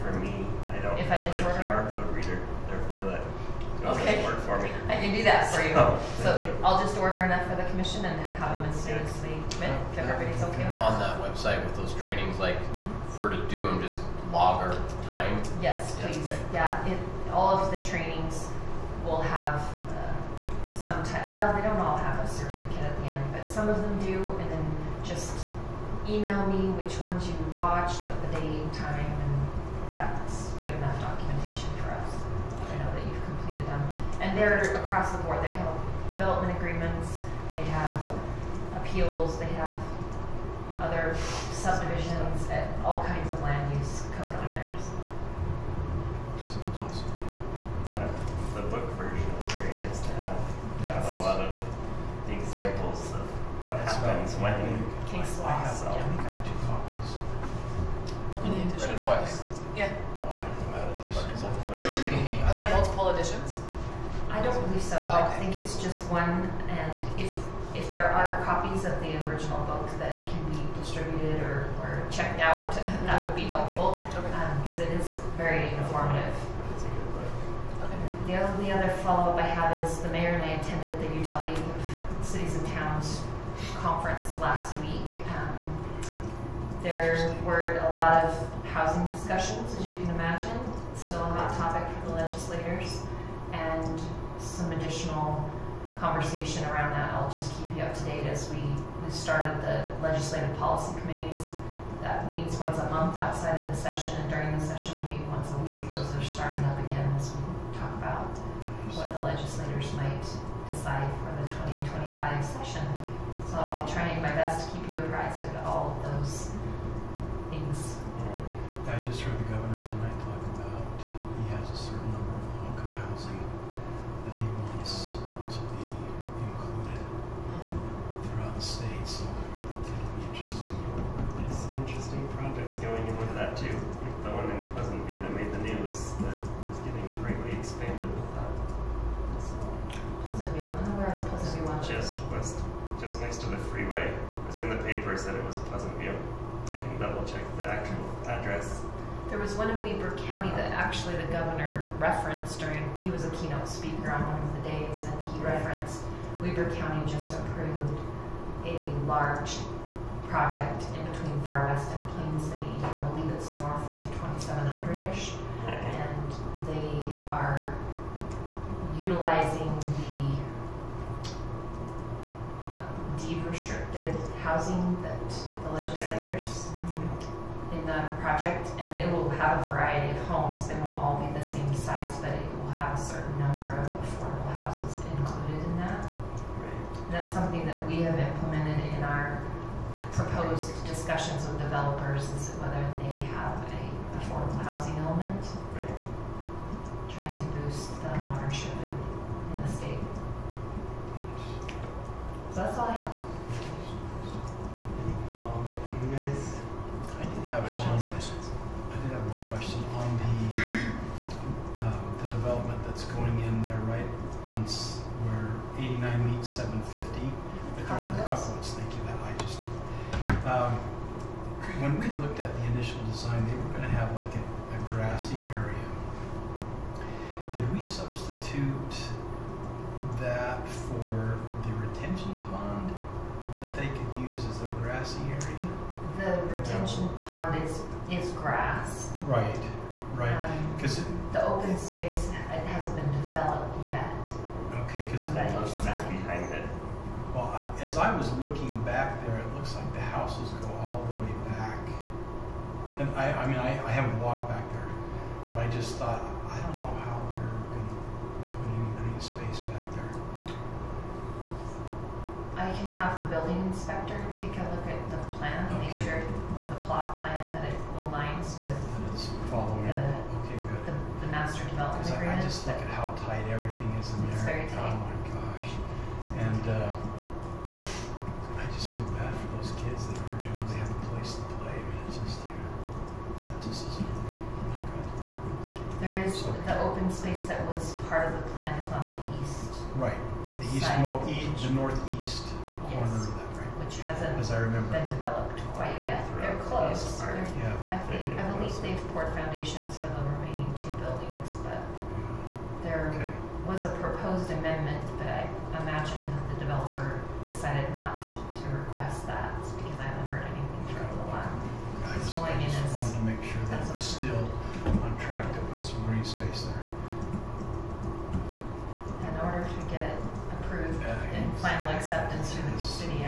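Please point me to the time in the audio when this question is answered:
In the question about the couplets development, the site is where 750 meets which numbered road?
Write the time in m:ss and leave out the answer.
3:35.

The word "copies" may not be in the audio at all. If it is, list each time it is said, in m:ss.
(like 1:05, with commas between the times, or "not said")
0:56, 1:08.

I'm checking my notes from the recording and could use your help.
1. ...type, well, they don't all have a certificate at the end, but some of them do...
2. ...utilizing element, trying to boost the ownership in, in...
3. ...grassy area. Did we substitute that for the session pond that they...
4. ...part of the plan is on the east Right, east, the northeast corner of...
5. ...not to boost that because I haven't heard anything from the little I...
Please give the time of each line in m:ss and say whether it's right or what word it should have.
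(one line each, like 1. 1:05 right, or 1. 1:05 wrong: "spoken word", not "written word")
1. 0:21 right
2. 3:14 wrong: "housing", not "utilizing"
3. 3:44 wrong: "retention", not "session"
4. 4:48 right
5. 5:07 wrong: "request", not "boost".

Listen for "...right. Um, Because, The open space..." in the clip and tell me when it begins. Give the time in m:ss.
4:00.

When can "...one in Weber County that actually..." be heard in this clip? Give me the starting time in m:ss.
2:29.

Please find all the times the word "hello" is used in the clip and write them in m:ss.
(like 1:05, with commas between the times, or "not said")
not said.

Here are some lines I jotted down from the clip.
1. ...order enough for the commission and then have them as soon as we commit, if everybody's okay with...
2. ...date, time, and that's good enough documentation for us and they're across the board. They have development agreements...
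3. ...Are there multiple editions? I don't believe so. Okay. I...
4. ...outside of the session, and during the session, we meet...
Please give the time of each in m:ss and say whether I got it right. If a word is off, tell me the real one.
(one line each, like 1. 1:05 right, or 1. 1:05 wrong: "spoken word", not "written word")
1. 0:06 right
2. 0:28 right
3. 1:02 right
4. 1:43 right.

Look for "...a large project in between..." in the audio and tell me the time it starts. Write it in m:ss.
2:38.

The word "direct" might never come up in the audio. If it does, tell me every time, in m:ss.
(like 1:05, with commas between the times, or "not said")
not said.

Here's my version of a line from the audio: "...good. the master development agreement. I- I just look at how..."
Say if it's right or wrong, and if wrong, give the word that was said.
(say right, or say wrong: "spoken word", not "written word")
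right.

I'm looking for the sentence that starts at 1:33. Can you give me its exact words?
And some additional conversation around that.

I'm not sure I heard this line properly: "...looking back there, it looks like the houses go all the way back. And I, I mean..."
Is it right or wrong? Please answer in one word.
right.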